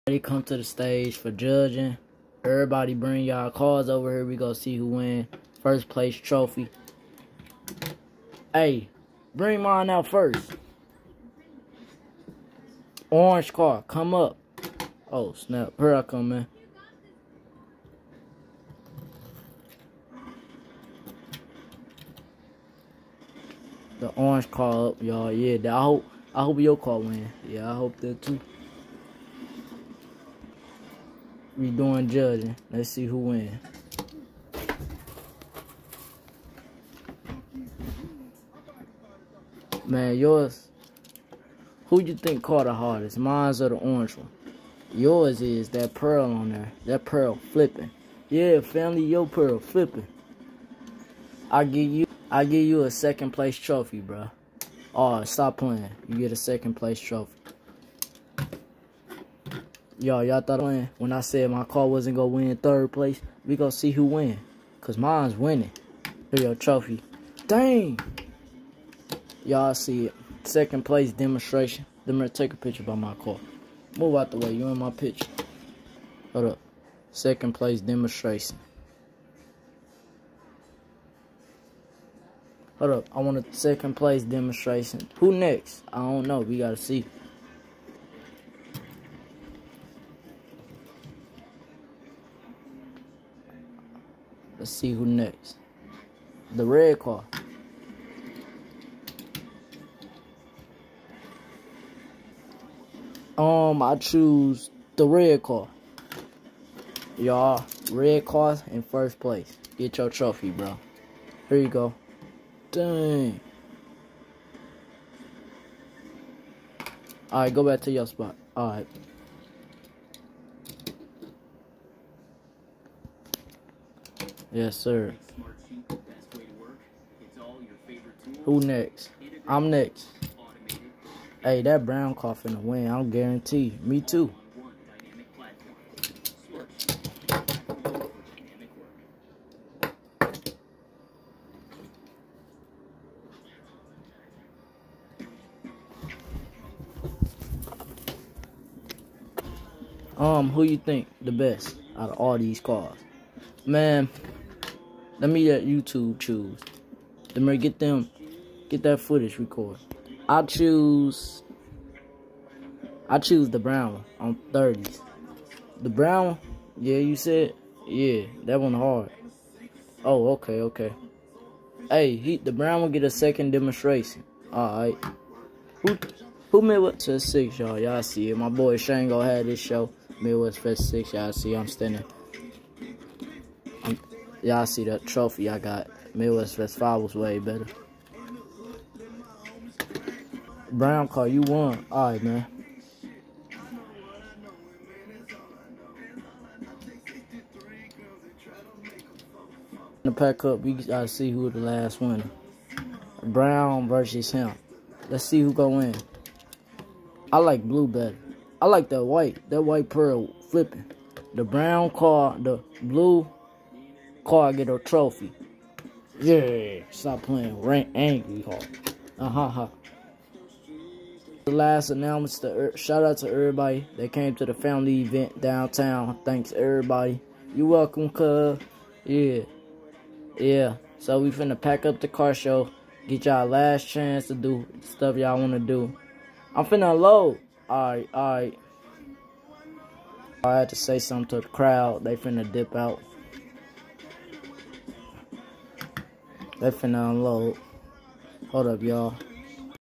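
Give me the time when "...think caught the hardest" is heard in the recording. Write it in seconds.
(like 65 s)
42 s.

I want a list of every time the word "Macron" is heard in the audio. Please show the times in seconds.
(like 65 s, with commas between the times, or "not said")
not said.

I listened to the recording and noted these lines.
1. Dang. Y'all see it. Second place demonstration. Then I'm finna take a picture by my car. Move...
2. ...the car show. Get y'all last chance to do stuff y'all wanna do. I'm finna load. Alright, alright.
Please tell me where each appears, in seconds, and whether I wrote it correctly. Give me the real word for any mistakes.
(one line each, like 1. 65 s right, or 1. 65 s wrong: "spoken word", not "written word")
1. 67 s wrong: "gonna", not "finna"
2. 231 s right.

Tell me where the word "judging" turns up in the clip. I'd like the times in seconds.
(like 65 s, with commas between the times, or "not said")
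1 s, 32 s.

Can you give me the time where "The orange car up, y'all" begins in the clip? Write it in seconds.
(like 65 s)
23 s.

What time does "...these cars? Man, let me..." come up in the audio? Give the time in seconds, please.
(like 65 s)
152 s.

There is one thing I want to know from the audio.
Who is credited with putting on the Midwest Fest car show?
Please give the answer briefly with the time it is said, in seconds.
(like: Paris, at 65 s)
Shango, at 178 s.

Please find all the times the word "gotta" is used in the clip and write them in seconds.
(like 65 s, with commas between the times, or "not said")
86 s, 200 s.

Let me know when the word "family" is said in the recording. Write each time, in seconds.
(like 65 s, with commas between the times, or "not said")
48 s, 224 s.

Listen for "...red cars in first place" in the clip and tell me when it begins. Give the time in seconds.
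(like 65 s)
107 s.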